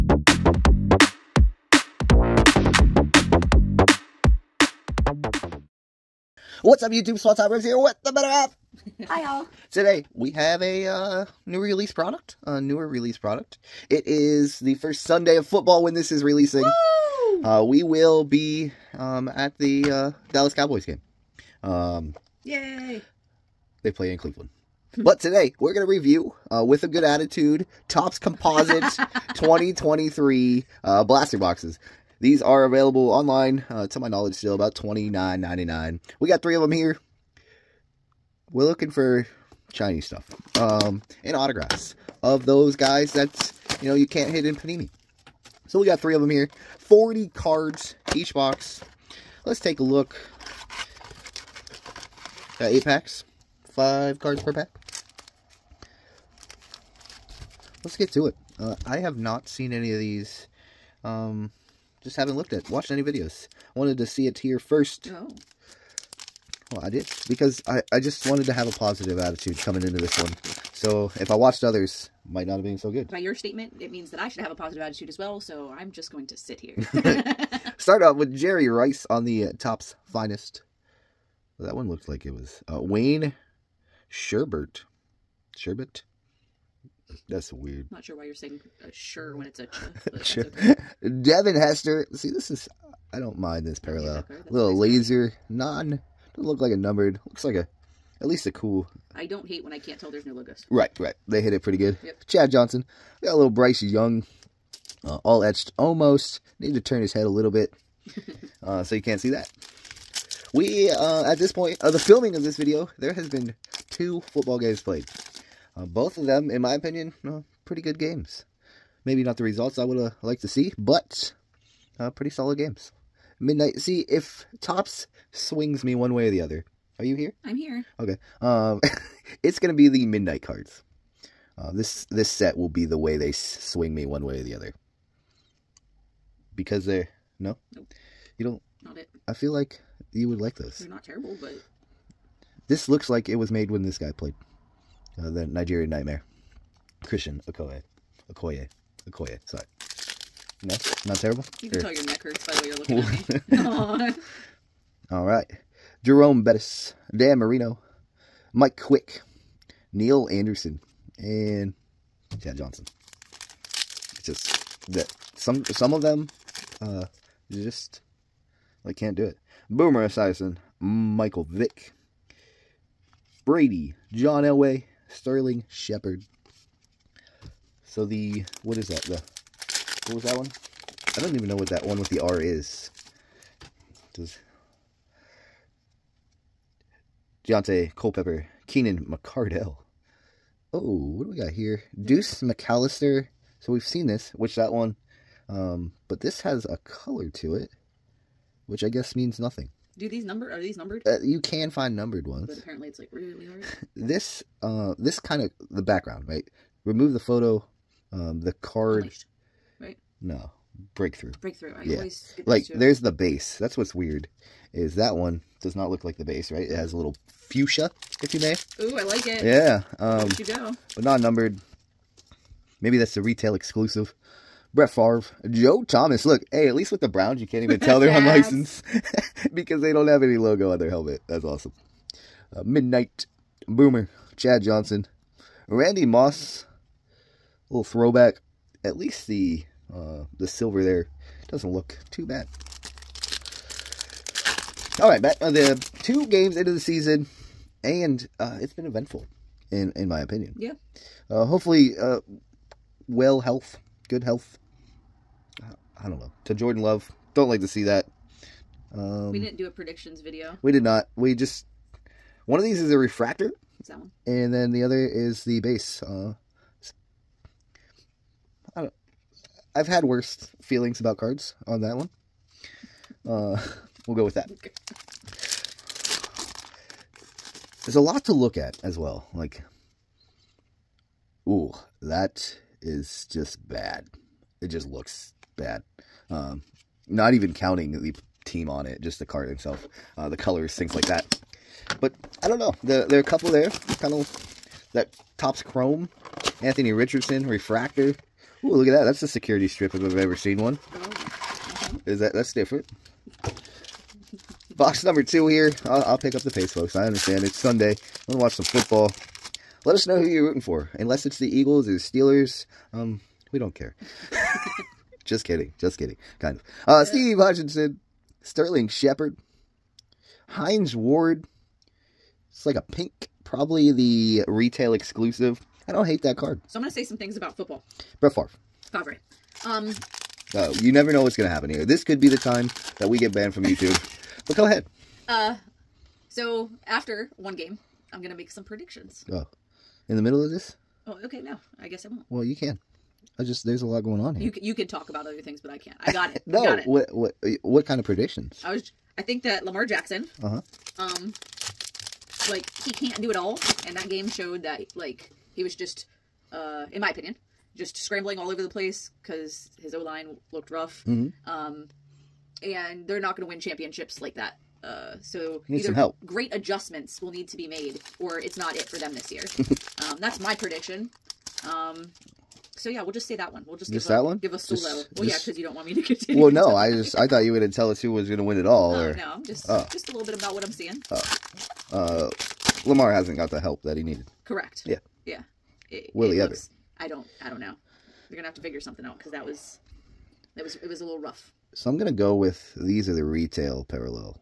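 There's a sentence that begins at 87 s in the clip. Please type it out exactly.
Not sure why you're saying uh, sure when it's a ch.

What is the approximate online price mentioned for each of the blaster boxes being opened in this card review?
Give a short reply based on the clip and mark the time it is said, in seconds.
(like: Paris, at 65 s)
$29.99, at 34 s.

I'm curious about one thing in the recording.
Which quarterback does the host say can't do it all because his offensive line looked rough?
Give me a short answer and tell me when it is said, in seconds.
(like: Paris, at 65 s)
Lamar Jackson, at 349 s.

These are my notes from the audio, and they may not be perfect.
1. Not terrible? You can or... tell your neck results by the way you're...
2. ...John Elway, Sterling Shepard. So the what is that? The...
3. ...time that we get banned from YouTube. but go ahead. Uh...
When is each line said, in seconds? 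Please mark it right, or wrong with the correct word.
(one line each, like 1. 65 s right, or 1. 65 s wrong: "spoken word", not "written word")
1. 151 s wrong: "hurts", not "results"
2. 174 s right
3. 332 s right.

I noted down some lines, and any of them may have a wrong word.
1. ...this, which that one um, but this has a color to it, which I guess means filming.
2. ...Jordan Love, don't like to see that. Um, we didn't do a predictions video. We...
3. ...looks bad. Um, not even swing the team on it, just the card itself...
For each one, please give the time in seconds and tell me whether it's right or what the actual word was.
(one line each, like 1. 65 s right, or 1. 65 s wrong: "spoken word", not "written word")
1. 194 s wrong: "nothing", not "filming"
2. 256 s right
3. 284 s wrong: "counting", not "swing".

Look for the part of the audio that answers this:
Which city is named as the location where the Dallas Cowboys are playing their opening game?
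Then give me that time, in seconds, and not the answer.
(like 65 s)
24 s.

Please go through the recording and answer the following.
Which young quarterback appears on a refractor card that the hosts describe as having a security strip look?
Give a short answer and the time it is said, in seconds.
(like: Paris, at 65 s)
Anthony Richardson, at 296 s.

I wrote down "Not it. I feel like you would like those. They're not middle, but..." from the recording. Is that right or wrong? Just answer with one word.
wrong.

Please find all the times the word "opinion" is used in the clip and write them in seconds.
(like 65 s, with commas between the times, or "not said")
116 s, 250 s, 357 s.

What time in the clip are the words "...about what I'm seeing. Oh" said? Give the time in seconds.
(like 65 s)
380 s.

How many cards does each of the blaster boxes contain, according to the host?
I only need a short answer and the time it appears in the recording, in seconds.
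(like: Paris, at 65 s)
40, at 46 s.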